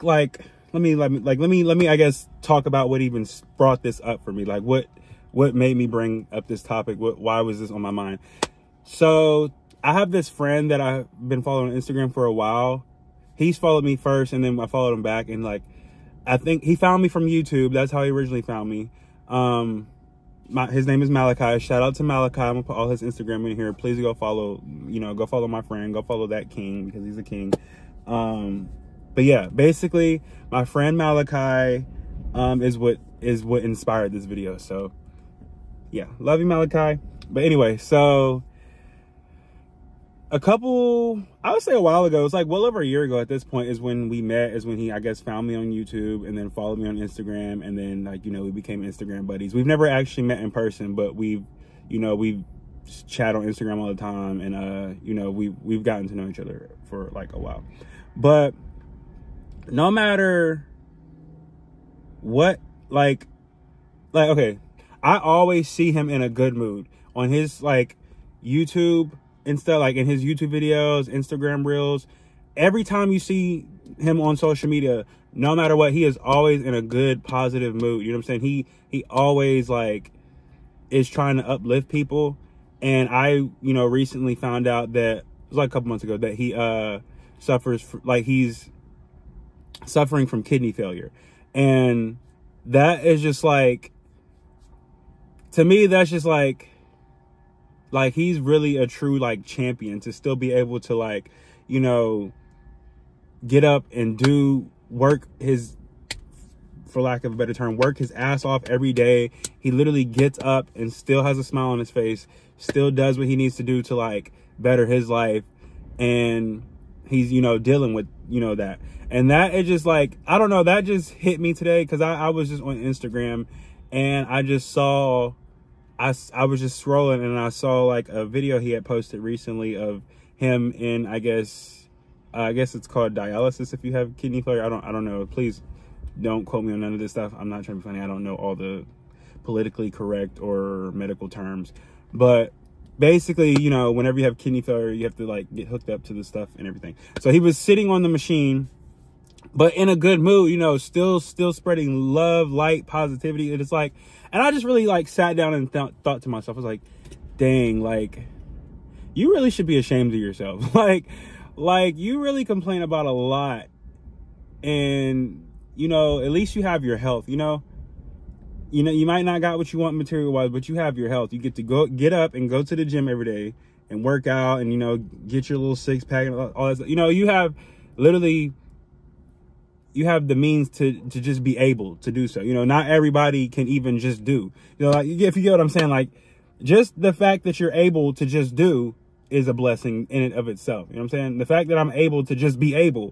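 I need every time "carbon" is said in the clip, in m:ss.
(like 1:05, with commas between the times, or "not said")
not said.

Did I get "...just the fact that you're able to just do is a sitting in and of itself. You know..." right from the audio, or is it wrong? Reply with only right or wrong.
wrong.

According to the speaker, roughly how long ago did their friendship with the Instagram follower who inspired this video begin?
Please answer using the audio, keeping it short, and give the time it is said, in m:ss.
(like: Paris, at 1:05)
Well over a year ago, at 0:42.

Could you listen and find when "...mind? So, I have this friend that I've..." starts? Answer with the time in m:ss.
0:07.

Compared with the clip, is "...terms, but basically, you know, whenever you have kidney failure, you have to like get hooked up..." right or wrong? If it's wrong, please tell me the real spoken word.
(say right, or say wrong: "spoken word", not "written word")
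right.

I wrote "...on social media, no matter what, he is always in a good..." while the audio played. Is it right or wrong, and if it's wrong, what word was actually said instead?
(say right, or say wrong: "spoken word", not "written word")
right.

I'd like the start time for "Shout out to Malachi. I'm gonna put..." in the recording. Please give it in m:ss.
0:21.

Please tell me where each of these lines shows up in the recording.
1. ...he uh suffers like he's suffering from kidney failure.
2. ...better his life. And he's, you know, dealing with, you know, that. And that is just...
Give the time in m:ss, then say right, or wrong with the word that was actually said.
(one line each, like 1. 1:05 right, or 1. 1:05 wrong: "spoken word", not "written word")
1. 1:26 right
2. 1:54 right.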